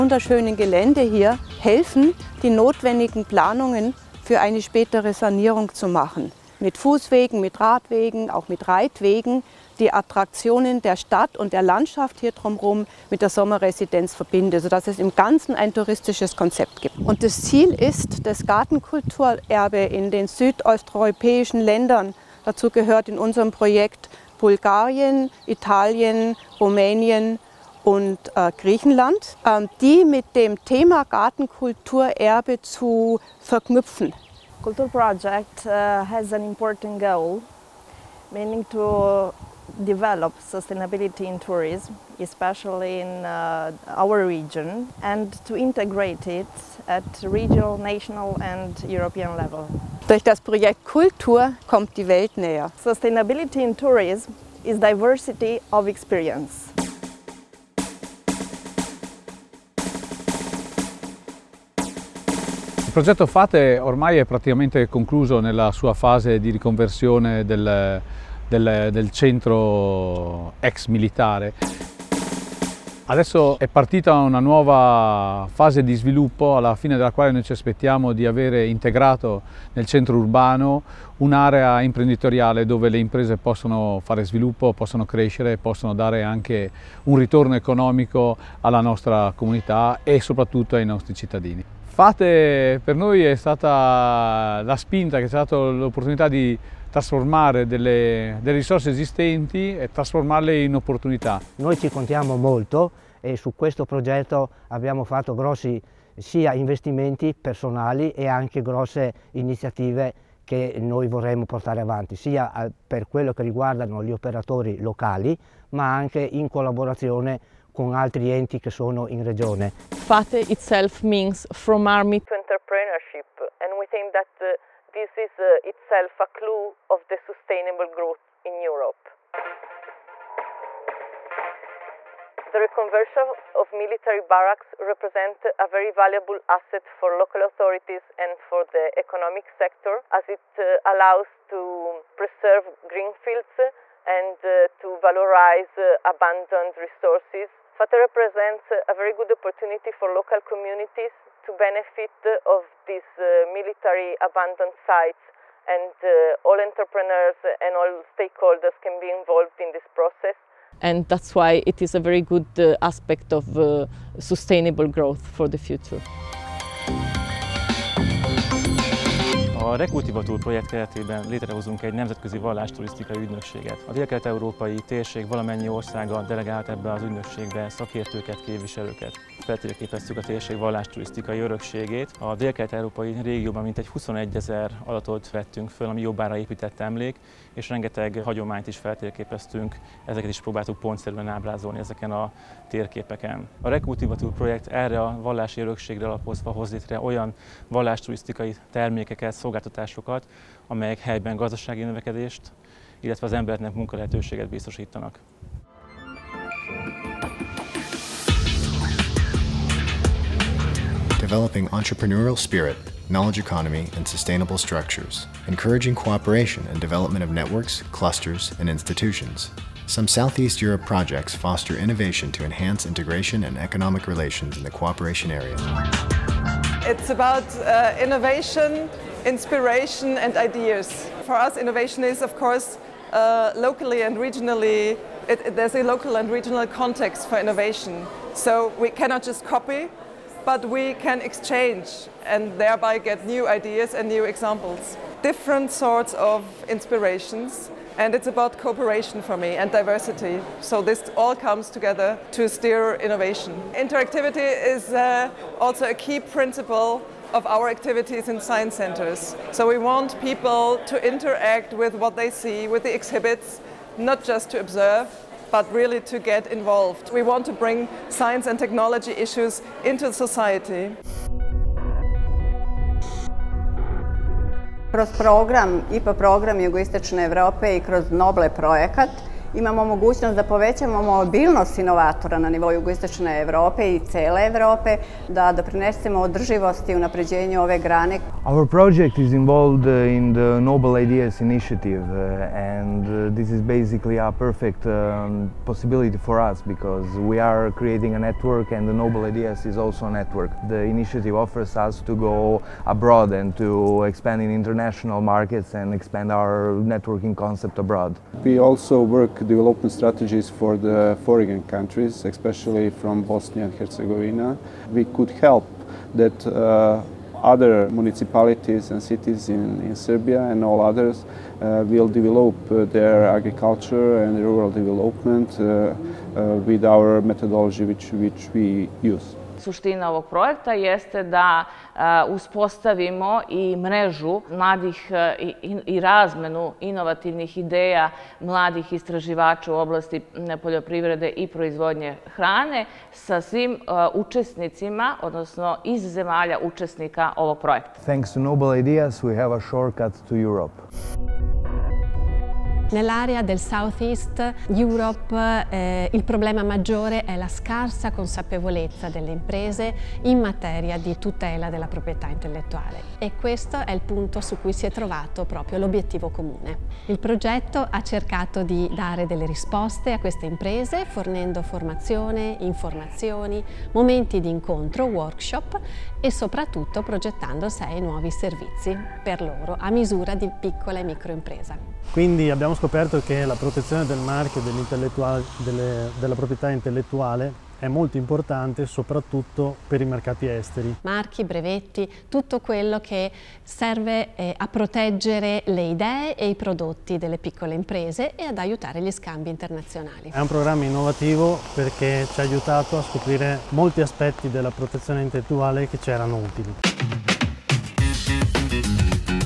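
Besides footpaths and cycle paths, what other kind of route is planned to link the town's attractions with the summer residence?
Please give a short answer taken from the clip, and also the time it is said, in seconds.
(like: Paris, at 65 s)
Reitwegen, at 8 s.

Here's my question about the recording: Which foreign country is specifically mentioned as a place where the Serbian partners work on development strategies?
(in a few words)
Bosnia and Herzegovina.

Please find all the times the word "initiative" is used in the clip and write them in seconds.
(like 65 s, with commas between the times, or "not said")
291 s, 300 s.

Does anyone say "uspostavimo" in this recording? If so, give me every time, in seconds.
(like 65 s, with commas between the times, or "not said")
332 s.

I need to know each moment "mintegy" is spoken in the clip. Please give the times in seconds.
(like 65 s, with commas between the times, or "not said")
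183 s.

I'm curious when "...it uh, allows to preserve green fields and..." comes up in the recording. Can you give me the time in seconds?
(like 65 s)
140 s.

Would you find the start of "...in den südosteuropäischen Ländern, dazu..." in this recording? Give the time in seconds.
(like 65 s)
19 s.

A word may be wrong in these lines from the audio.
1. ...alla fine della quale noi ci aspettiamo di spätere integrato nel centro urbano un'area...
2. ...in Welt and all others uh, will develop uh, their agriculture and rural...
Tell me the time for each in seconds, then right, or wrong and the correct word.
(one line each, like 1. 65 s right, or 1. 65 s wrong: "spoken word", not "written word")
1. 76 s wrong: "avere", not "spätere"
2. 319 s wrong: "Serbia", not "Welt".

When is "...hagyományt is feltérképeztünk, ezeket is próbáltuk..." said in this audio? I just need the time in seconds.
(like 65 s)
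188 s.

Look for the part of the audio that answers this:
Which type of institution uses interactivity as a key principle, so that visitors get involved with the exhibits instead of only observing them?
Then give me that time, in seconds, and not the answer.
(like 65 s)
258 s.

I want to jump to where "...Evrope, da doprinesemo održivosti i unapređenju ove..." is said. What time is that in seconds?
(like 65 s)
284 s.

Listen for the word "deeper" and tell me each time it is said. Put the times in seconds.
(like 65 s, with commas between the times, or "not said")
not said.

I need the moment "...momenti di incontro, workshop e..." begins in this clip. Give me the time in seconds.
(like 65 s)
373 s.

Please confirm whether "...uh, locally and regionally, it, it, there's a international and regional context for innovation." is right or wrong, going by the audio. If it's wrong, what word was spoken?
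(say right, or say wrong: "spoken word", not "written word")
wrong: "local", not "international".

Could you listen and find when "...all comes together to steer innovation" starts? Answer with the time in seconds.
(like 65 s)
251 s.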